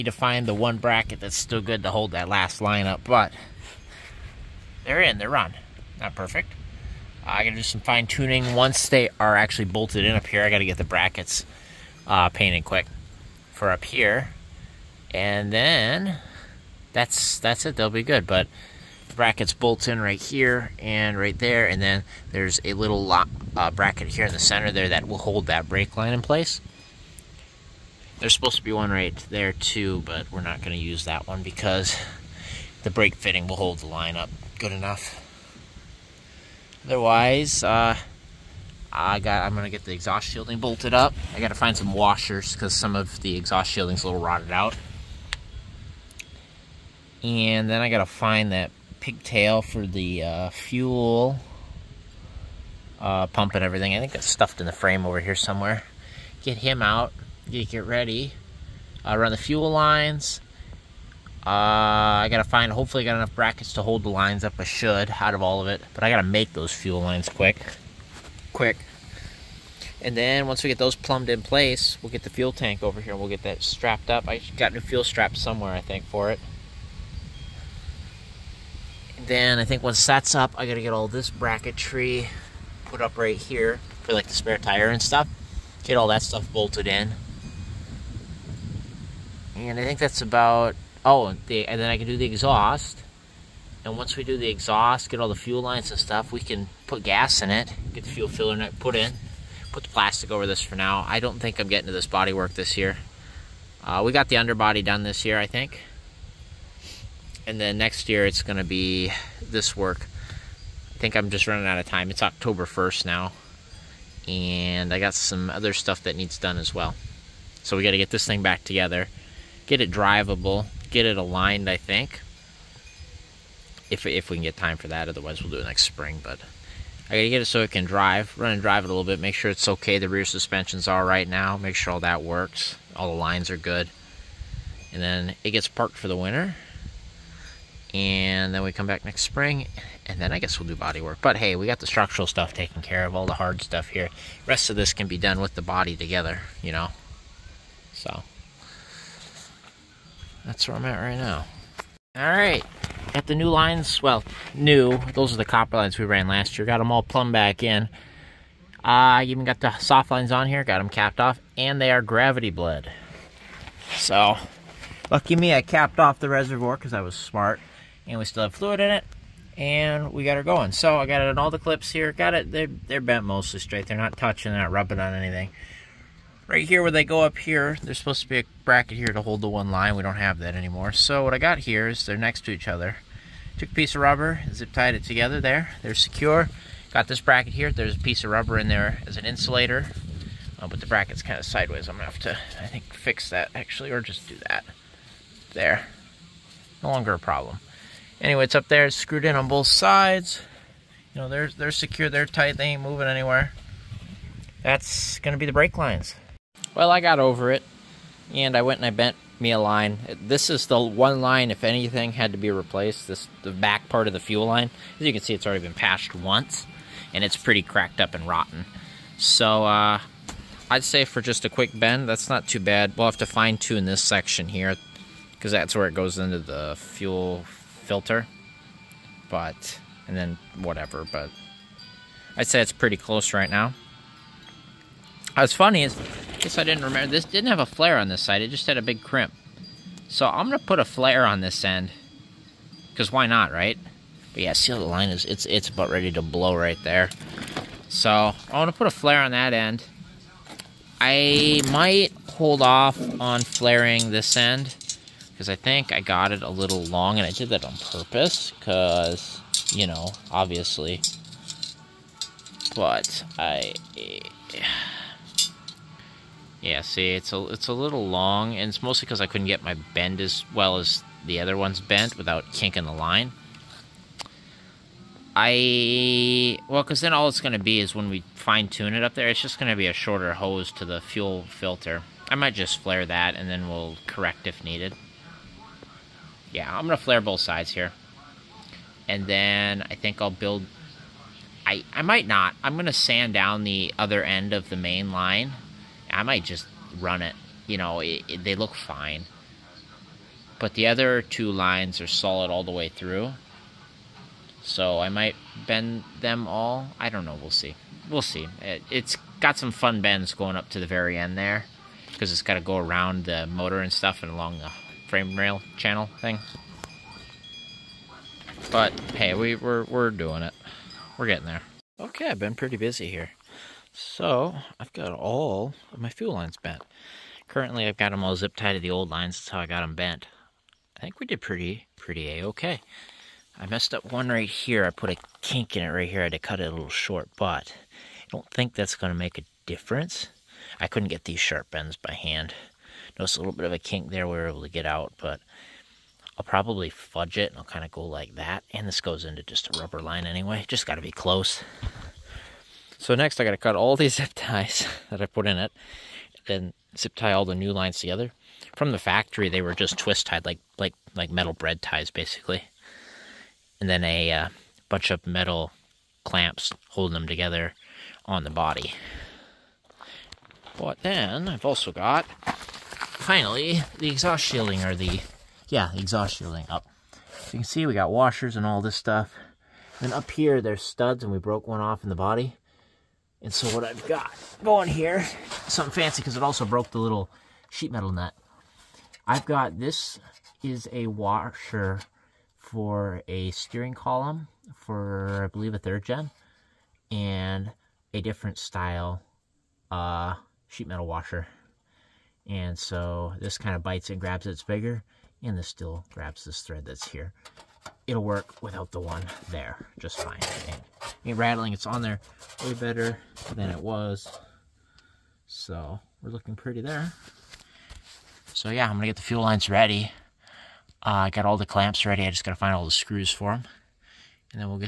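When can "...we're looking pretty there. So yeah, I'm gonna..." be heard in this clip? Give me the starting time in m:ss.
6:56.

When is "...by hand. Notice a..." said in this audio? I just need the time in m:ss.
5:41.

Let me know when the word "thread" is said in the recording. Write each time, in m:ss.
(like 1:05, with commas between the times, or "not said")
6:46.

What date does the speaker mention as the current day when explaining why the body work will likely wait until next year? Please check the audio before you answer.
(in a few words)
October 1st.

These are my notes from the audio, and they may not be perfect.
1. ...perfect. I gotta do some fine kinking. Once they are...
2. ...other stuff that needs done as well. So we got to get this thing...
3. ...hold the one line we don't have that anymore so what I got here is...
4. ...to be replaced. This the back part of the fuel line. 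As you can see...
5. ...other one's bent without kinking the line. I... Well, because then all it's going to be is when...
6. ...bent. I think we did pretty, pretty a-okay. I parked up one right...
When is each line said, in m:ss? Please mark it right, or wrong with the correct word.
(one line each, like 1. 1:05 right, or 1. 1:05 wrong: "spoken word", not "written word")
1. 0:06 wrong: "tuning", not "kinking"
2. 1:55 right
3. 2:59 right
4. 3:32 right
5. 4:31 right
6. 5:29 wrong: "messed", not "parked".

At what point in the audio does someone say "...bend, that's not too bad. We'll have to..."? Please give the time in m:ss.
3:41.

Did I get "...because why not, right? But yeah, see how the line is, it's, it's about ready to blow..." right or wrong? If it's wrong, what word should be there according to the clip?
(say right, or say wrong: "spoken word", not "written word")
right.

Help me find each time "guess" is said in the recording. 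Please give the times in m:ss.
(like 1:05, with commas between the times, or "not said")
2:20, 3:56.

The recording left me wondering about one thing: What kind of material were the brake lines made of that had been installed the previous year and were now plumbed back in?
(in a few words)
Copper.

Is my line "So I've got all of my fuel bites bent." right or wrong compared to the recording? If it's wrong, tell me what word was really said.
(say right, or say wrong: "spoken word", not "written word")
wrong: "lines", not "bites".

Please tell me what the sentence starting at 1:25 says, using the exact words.
Get all that stuff bolted in.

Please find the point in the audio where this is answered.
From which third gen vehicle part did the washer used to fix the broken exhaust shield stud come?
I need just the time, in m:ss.
6:33.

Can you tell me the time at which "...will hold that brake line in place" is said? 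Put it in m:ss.
0:25.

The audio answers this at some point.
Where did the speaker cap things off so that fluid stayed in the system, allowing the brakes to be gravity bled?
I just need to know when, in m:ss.
2:46.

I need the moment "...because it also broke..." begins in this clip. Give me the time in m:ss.
6:26.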